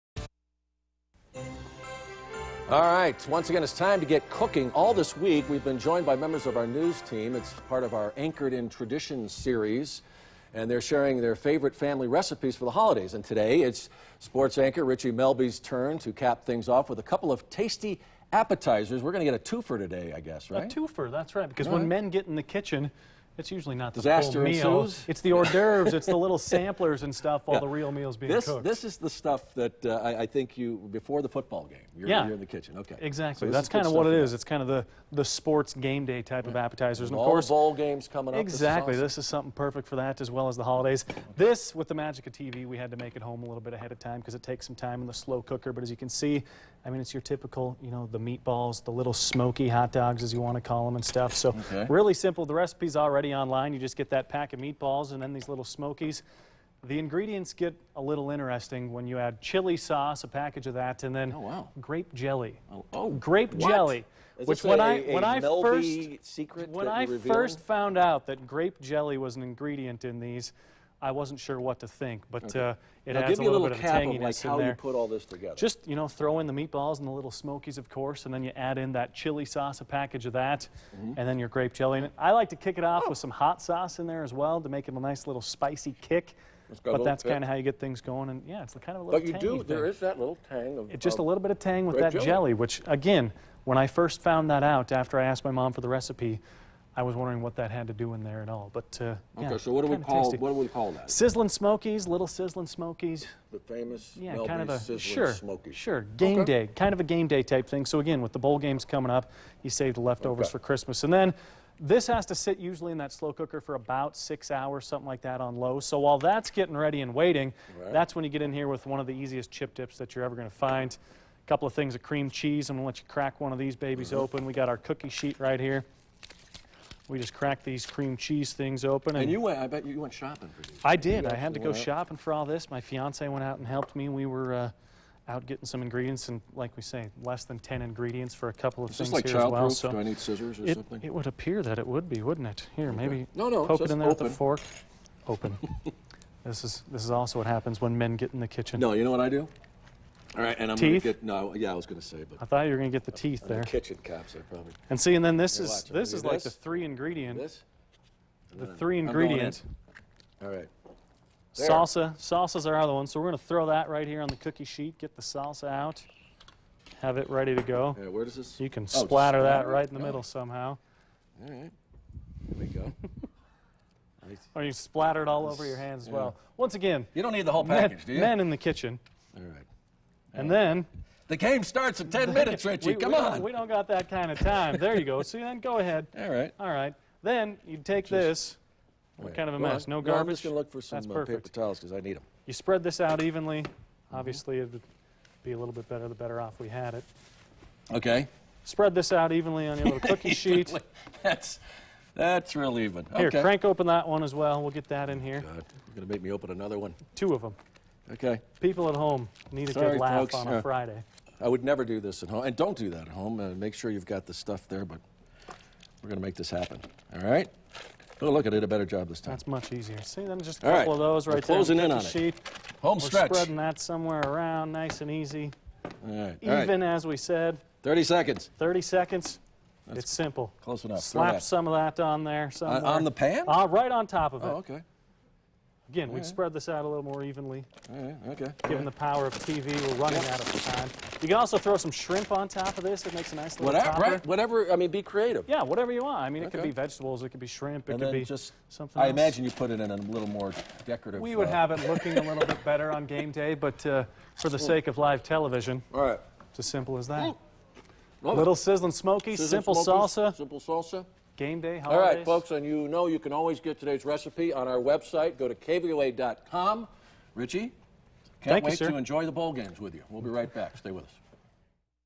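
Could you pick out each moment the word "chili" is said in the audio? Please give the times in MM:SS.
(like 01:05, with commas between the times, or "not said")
00:59, 01:19.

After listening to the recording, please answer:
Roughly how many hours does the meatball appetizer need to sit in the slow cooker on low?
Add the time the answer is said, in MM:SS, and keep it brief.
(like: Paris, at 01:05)
6, at 01:54.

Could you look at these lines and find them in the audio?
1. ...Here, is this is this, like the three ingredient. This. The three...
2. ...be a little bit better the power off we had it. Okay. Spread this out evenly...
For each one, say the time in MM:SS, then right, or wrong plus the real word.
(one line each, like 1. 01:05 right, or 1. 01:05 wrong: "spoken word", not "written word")
1. 02:35 right
2. 03:15 wrong: "better", not "power".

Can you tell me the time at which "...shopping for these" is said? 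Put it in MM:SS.
02:10.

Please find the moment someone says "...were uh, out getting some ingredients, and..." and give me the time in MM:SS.
02:14.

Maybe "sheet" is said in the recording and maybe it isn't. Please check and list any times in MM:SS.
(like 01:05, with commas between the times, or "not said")
02:05, 02:44, 03:20.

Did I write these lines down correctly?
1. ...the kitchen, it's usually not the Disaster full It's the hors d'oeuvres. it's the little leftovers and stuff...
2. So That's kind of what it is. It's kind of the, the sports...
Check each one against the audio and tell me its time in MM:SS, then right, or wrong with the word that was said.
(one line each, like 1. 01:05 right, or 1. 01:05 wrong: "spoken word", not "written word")
1. 00:22 wrong: "samplers", not "leftovers"
2. 00:33 right.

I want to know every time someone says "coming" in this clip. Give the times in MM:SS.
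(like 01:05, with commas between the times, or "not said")
00:38, 01:48.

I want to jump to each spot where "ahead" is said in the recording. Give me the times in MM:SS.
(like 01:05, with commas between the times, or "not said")
00:43, 03:05.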